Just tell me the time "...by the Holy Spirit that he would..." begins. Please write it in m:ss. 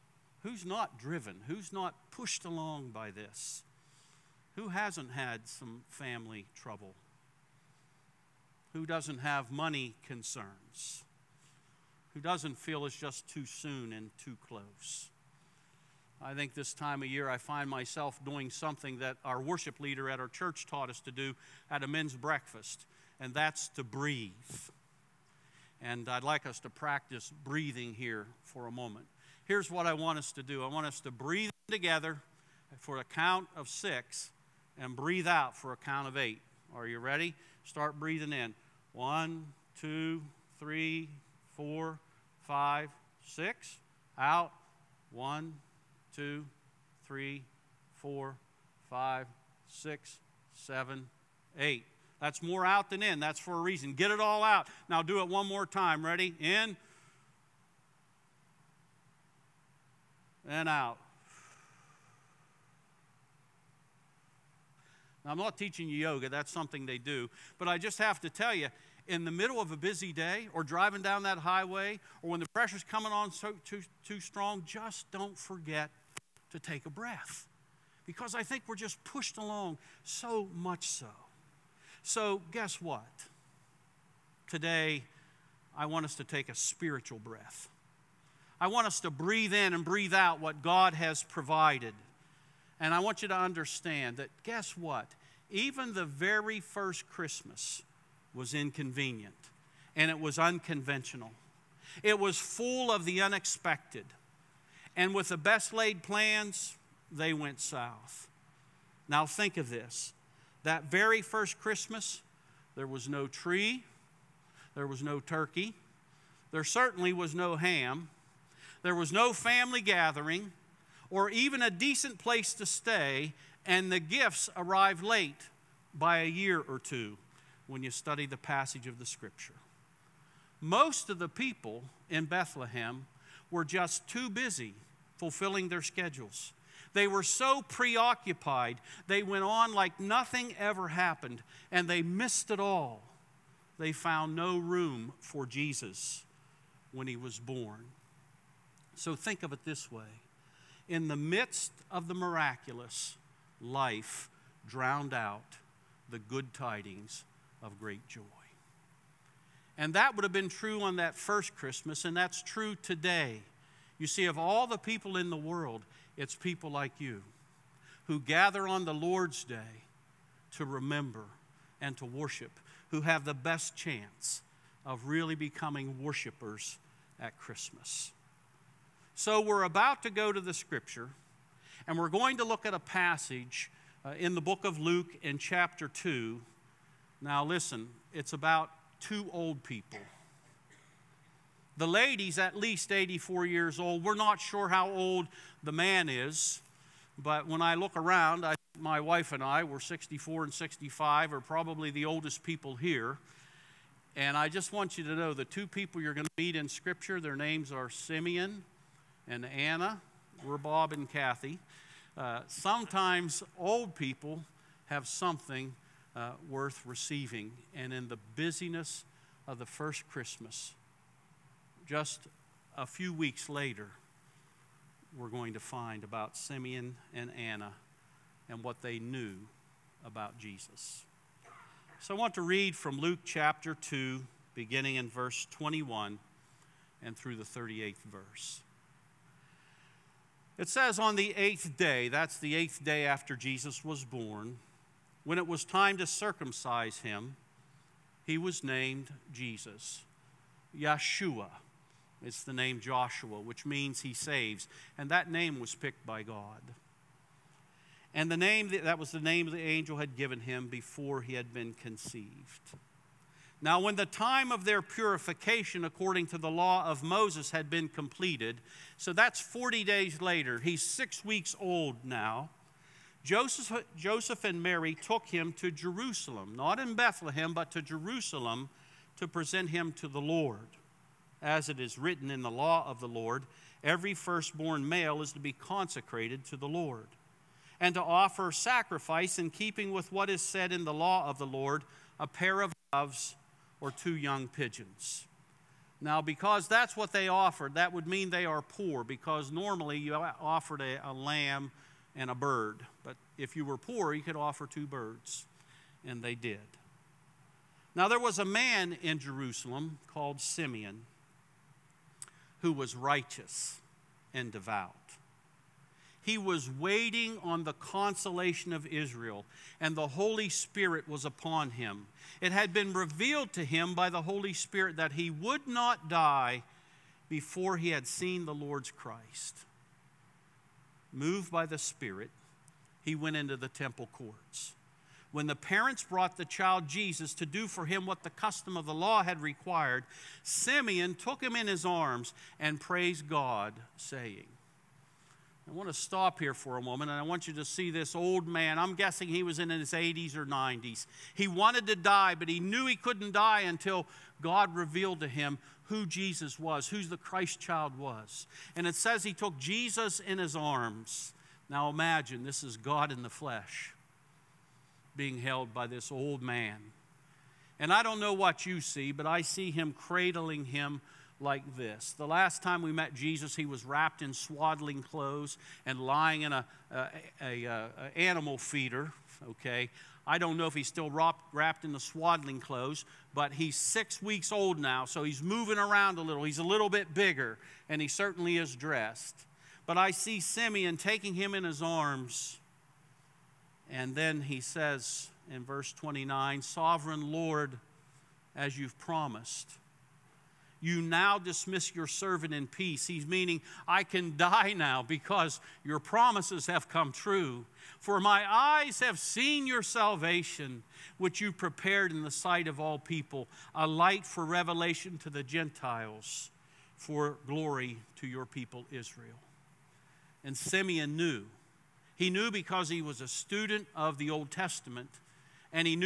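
5:23.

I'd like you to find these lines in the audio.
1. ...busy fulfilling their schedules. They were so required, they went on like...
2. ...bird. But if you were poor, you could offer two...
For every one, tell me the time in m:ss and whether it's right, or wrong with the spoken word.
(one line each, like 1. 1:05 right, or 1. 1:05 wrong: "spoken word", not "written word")
1. 2:14 wrong: "preoccupied", not "required"
2. 5:02 right.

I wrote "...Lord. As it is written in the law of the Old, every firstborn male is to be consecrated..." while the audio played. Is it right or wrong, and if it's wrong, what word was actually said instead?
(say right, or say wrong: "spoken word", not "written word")
wrong: "Lord", not "Old".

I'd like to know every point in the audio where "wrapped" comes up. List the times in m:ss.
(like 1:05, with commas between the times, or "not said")
6:13, 6:21.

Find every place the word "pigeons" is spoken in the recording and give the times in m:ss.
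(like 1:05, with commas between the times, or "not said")
4:54.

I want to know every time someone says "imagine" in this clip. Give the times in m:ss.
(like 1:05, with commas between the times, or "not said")
6:01.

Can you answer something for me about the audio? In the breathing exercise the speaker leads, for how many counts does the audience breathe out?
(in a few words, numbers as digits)
8.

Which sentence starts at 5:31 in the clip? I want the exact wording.
Moved by the Spirit, he went into the temple courts.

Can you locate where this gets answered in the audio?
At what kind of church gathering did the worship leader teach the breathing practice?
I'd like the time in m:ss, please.
0:21.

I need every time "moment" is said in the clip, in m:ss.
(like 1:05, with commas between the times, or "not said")
0:28, 5:46.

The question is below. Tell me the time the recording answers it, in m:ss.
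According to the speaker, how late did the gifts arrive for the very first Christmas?
2:06.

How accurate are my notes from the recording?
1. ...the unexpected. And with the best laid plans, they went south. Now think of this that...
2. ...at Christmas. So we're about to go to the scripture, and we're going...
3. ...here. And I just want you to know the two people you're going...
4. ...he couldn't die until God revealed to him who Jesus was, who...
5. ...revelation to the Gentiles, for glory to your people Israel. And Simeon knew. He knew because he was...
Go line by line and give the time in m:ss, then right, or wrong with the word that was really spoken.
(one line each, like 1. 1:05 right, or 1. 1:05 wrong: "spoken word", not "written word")
1. 1:43 right
2. 2:57 right
3. 3:22 right
4. 5:52 right
5. 6:54 right.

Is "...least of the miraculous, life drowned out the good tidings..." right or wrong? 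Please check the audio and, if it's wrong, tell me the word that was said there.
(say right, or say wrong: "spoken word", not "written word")
wrong: "midst", not "least".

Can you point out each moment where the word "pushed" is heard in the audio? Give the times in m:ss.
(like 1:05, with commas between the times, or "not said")
0:02, 1:19.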